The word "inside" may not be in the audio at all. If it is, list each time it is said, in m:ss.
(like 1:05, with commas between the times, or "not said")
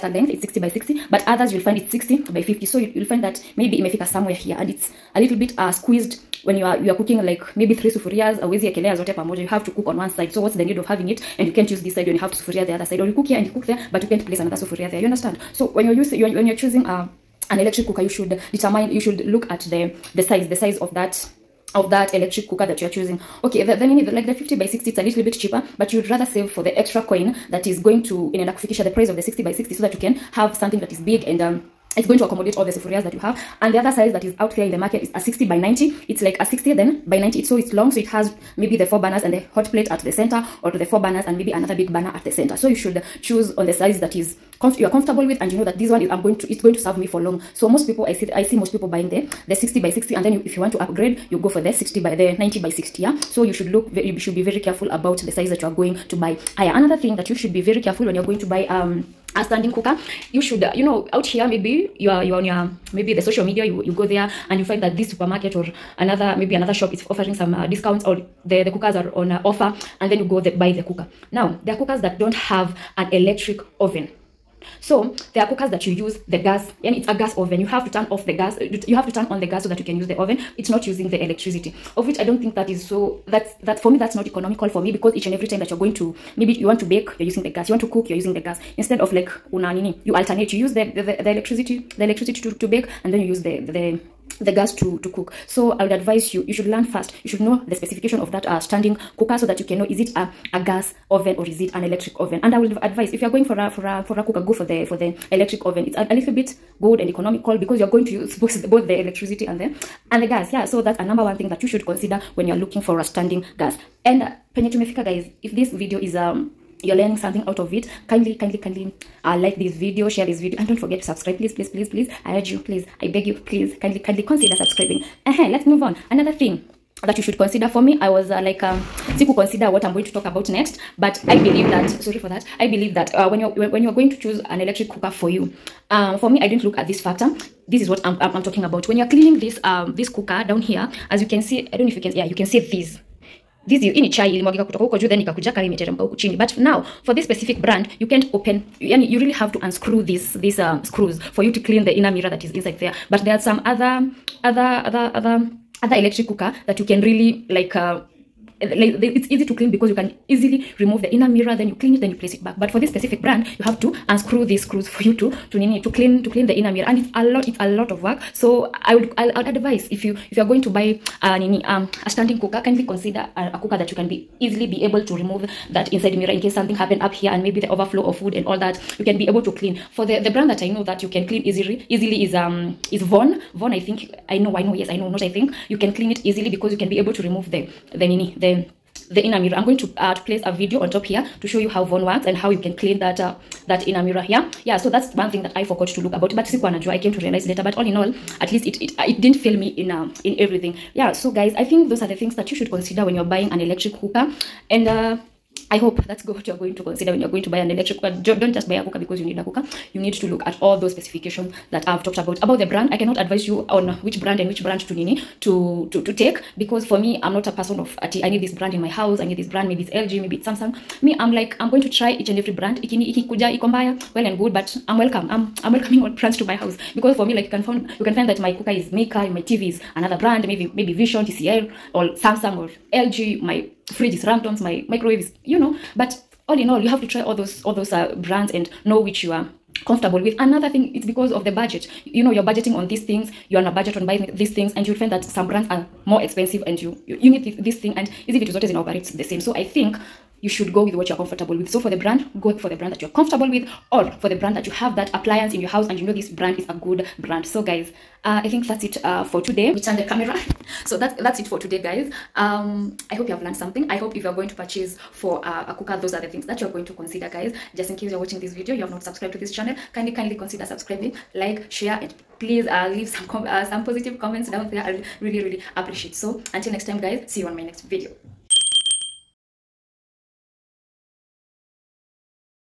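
2:32, 2:55.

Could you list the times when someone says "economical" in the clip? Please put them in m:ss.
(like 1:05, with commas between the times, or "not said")
1:24, 1:47.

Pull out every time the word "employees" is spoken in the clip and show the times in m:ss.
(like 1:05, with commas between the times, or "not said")
not said.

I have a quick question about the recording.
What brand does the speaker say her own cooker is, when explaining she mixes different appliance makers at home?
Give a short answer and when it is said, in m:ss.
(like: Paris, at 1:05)
Mika, at 3:48.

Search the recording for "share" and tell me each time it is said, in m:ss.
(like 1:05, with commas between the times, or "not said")
2:00, 4:31.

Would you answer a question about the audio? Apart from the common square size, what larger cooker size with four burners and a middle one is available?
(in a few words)
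60 by 90.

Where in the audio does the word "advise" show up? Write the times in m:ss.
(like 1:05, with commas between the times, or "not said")
1:35, 1:42, 2:49, 3:33.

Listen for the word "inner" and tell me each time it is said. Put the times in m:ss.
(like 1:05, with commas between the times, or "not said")
2:31, 2:41, 2:46, 3:09, 3:13.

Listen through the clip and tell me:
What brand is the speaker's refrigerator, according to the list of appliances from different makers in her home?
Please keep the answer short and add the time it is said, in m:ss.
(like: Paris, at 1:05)
Ramtons, at 3:54.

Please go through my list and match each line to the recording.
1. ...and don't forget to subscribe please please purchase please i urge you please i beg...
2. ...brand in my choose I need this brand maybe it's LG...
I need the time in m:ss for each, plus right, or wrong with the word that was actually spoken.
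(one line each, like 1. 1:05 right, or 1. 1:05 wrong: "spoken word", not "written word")
1. 2:00 wrong: "please", not "purchase"
2. 3:38 wrong: "house", not "choose".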